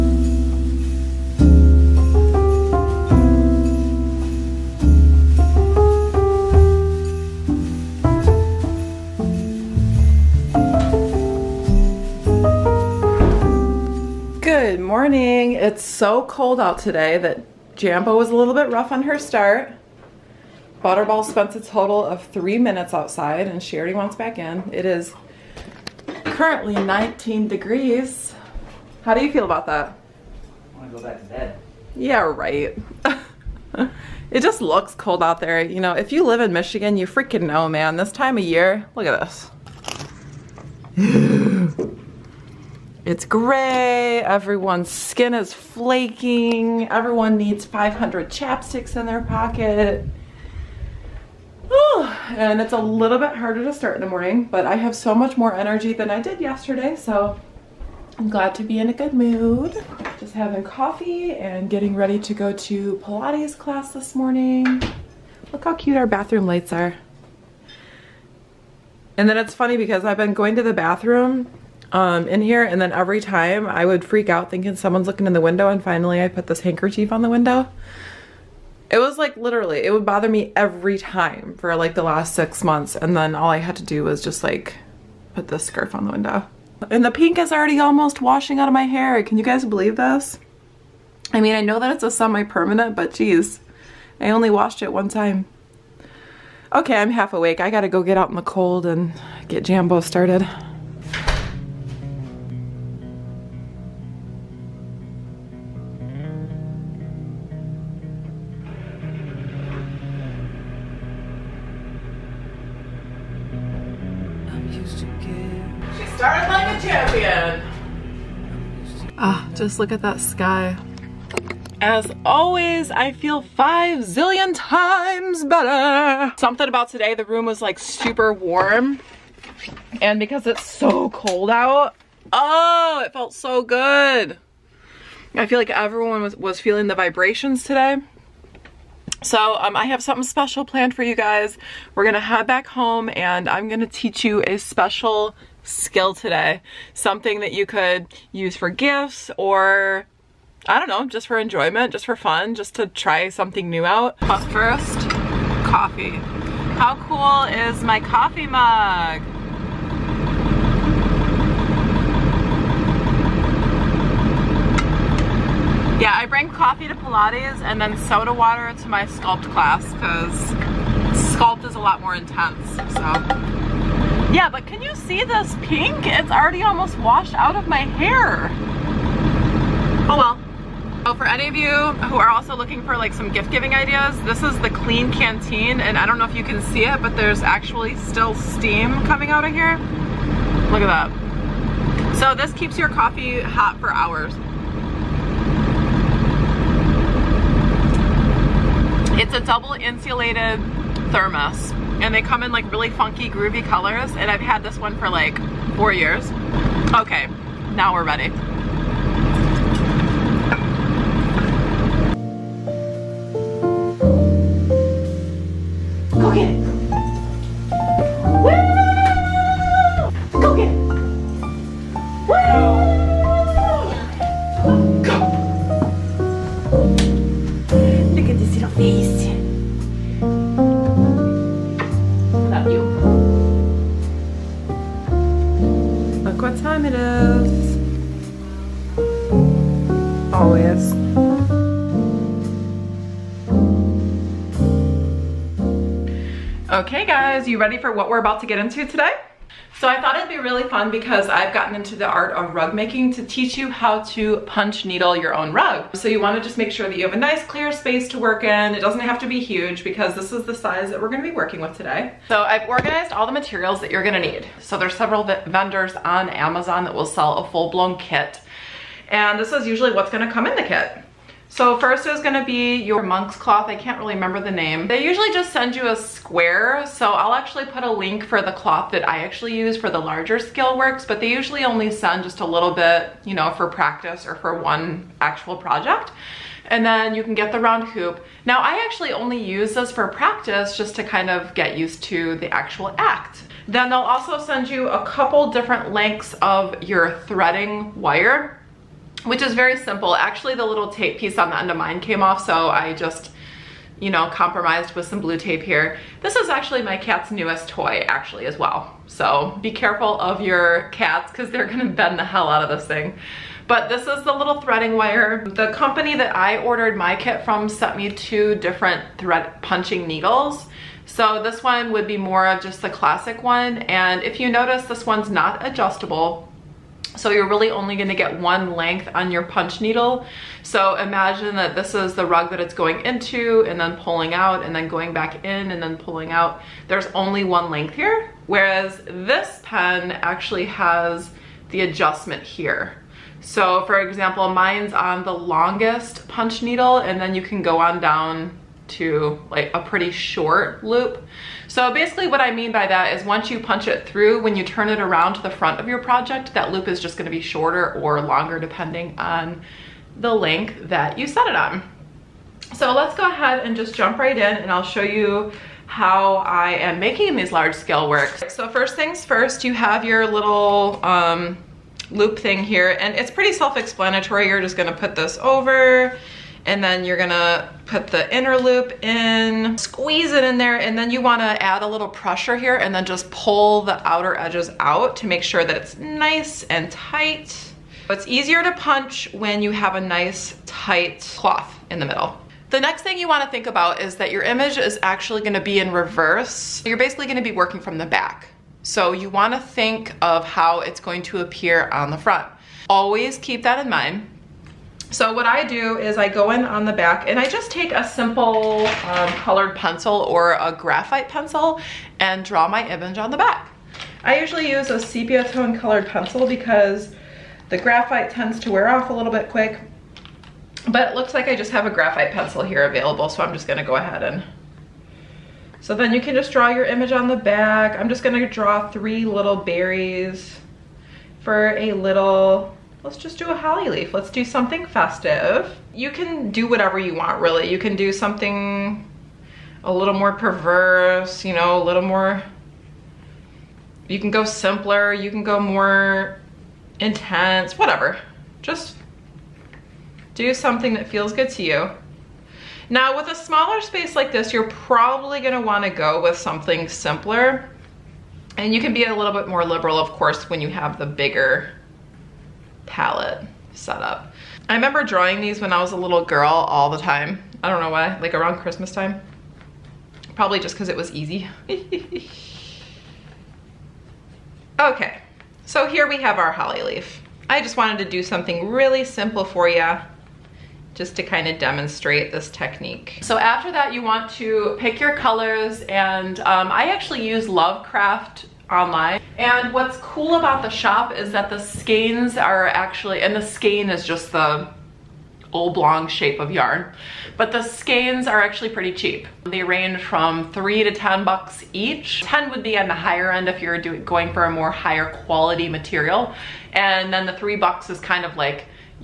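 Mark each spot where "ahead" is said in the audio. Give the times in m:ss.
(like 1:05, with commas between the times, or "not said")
6:03, 7:03.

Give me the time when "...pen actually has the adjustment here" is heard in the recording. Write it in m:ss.
5:39.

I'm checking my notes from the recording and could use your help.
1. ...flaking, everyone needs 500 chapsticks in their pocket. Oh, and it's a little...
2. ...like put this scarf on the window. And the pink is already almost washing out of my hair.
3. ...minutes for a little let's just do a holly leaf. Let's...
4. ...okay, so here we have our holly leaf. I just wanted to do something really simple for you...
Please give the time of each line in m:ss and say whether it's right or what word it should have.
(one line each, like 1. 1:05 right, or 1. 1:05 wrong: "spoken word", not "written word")
1. 0:45 right
2. 1:24 right
3. 7:09 wrong: "berries", not "minutes"
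4. 7:54 right.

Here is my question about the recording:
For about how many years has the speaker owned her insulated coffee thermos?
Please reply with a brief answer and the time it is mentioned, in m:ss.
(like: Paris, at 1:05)
4 years, at 3:25.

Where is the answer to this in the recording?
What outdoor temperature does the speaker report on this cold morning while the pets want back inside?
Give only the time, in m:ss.
0:26.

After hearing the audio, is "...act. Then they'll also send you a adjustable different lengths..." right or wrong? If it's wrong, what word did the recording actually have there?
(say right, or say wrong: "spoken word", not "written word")
wrong: "couple", not "adjustable".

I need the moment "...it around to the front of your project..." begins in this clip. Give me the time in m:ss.
5:54.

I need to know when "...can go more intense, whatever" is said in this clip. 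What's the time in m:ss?
7:25.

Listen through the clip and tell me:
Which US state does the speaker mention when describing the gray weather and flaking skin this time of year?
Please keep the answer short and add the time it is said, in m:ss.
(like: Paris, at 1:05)
Michigan, at 0:36.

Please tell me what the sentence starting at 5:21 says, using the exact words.
So this one would be more of just the classic one.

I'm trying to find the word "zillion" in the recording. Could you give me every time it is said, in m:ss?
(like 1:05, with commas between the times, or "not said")
2:04.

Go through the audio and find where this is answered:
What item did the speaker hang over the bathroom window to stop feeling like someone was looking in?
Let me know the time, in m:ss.
1:16.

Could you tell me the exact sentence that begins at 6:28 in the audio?
It's easier to punch when you have a nice tight cloth in the middle.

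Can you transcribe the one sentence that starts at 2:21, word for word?
We're gonna head back home and I'm gonna teach you a special skill today.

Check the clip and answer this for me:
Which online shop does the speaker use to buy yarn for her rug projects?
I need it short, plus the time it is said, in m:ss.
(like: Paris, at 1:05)
Lovecraft, at 8:07.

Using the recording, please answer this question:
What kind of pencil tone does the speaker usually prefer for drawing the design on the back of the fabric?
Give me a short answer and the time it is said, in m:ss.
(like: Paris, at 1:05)
sepia, at 6:54.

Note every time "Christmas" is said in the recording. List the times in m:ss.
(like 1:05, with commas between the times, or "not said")
7:48.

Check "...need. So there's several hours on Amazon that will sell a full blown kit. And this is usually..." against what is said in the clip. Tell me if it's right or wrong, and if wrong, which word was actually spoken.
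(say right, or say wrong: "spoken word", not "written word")
wrong: "vendors", not "hours".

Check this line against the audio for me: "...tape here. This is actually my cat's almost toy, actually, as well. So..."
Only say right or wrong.
wrong.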